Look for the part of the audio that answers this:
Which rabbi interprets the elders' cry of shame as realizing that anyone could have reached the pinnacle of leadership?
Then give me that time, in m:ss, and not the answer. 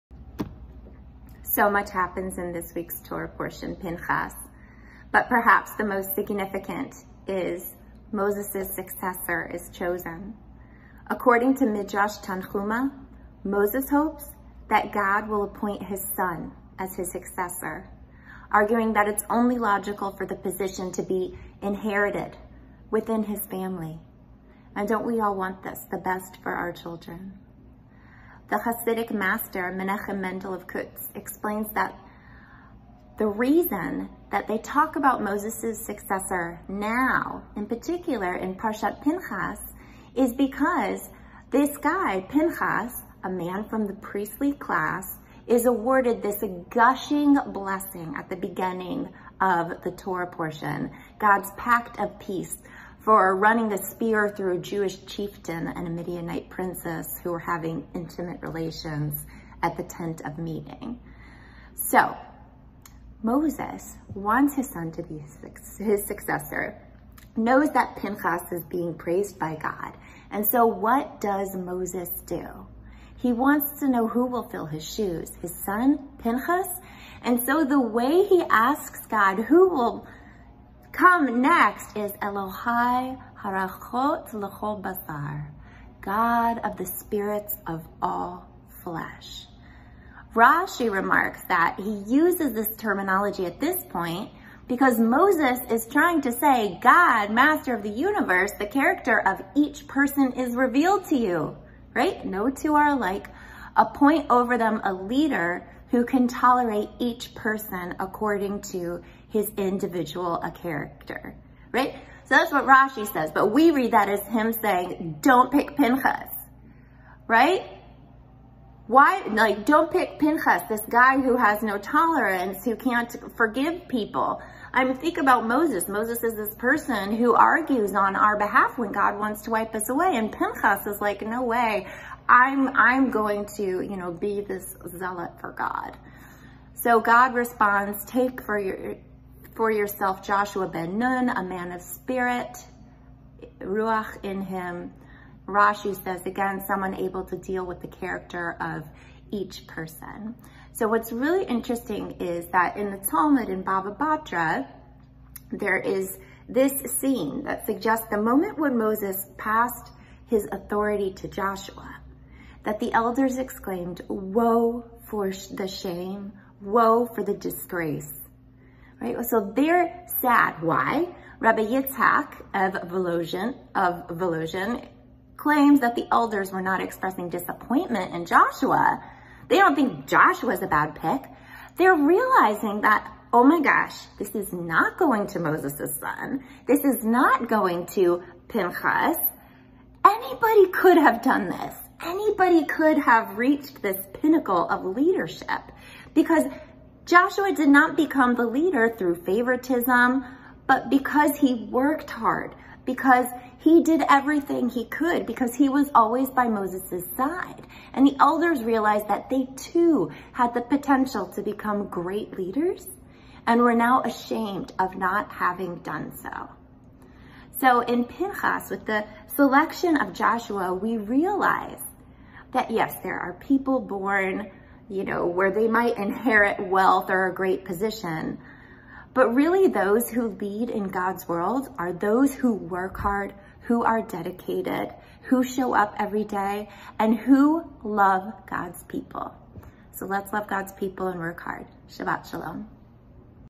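2:51.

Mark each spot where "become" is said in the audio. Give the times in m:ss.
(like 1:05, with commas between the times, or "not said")
3:17, 3:31.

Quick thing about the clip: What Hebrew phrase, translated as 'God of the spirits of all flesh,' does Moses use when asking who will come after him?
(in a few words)
Elohai Harachot Lechol Basar.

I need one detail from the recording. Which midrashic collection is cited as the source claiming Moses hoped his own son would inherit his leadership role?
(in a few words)
Midrash Tanhuma.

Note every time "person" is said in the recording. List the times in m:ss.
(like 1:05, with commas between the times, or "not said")
1:39, 1:47, 2:06, 2:29.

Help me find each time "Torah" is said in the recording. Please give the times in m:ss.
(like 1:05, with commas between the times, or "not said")
0:03, 0:49.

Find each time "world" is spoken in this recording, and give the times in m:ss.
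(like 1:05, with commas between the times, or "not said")
3:51.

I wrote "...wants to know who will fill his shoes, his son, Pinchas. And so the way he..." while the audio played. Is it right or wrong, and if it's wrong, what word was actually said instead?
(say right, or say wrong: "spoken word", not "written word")
right.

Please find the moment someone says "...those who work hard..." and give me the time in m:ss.
3:51.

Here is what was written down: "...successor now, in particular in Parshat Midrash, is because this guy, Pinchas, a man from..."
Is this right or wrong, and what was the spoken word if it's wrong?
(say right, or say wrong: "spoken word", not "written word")
wrong: "Pinchas", not "Midrash".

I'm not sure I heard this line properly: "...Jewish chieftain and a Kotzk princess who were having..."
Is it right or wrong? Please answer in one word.
wrong.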